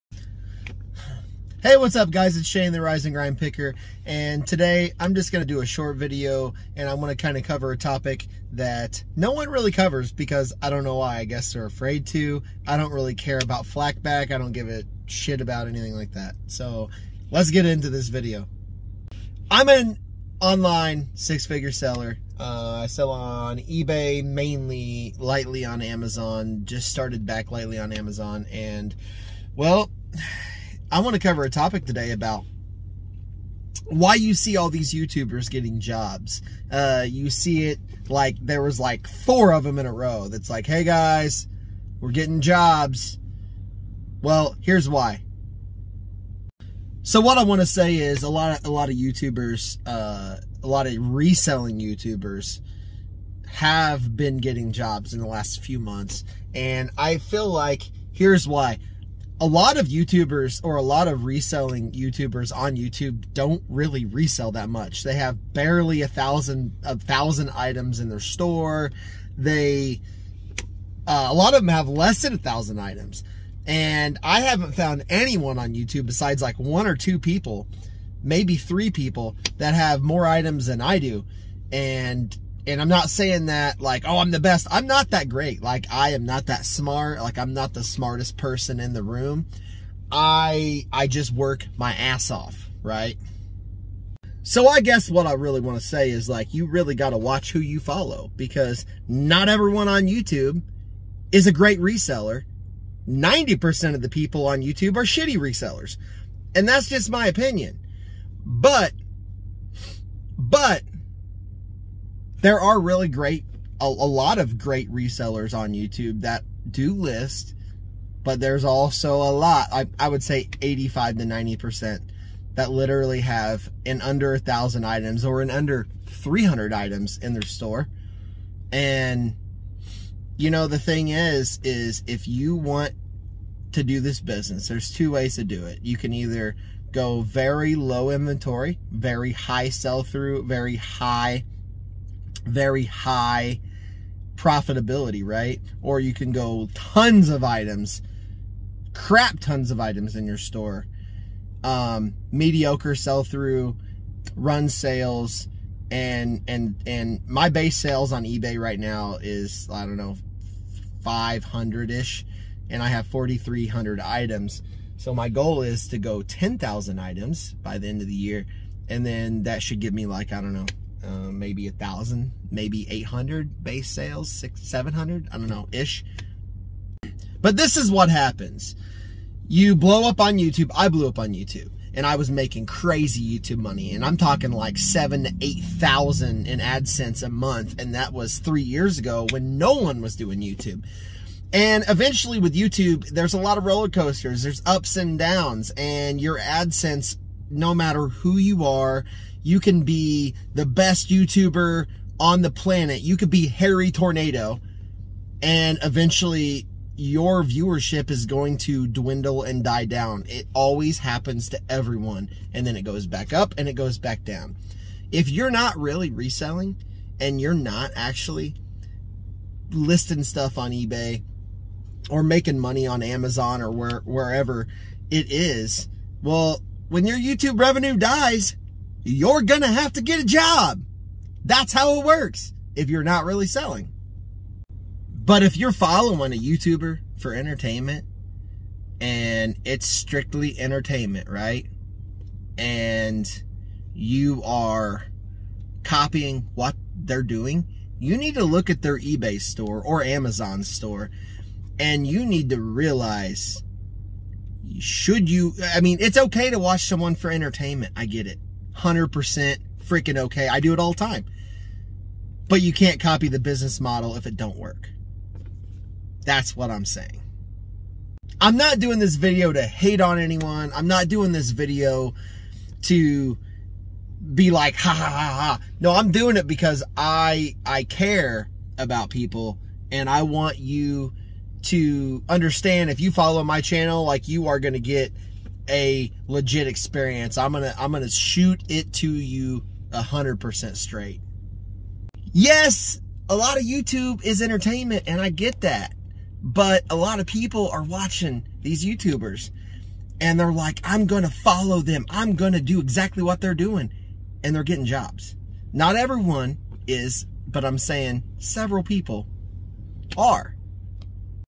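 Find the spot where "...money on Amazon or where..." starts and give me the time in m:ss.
3:42.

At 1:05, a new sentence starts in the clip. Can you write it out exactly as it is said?
They have barely a thousand a thousand items in their store.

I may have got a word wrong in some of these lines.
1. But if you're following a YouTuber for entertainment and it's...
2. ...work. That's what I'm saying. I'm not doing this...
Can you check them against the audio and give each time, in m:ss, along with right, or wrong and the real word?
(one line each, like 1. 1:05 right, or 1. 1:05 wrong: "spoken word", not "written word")
1. 3:55 right
2. 4:24 right.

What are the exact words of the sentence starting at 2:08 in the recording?
And you know, the thing is, is if you want to do this business, there's two ways to do it.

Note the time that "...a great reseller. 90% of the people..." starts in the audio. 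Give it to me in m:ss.
1:41.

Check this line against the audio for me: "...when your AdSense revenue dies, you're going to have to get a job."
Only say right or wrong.
wrong.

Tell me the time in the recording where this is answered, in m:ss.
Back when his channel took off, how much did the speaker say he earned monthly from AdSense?
3:04.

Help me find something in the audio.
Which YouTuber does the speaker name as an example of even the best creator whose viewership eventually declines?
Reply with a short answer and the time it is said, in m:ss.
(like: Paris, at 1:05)
Hairy Tornado, at 3:23.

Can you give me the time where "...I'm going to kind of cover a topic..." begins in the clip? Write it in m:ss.
0:06.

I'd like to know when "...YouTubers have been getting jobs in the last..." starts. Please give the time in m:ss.
0:51.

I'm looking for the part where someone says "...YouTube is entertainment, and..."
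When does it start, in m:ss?
4:53.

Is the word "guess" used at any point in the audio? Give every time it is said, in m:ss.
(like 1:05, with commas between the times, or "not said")
0:11, 1:34.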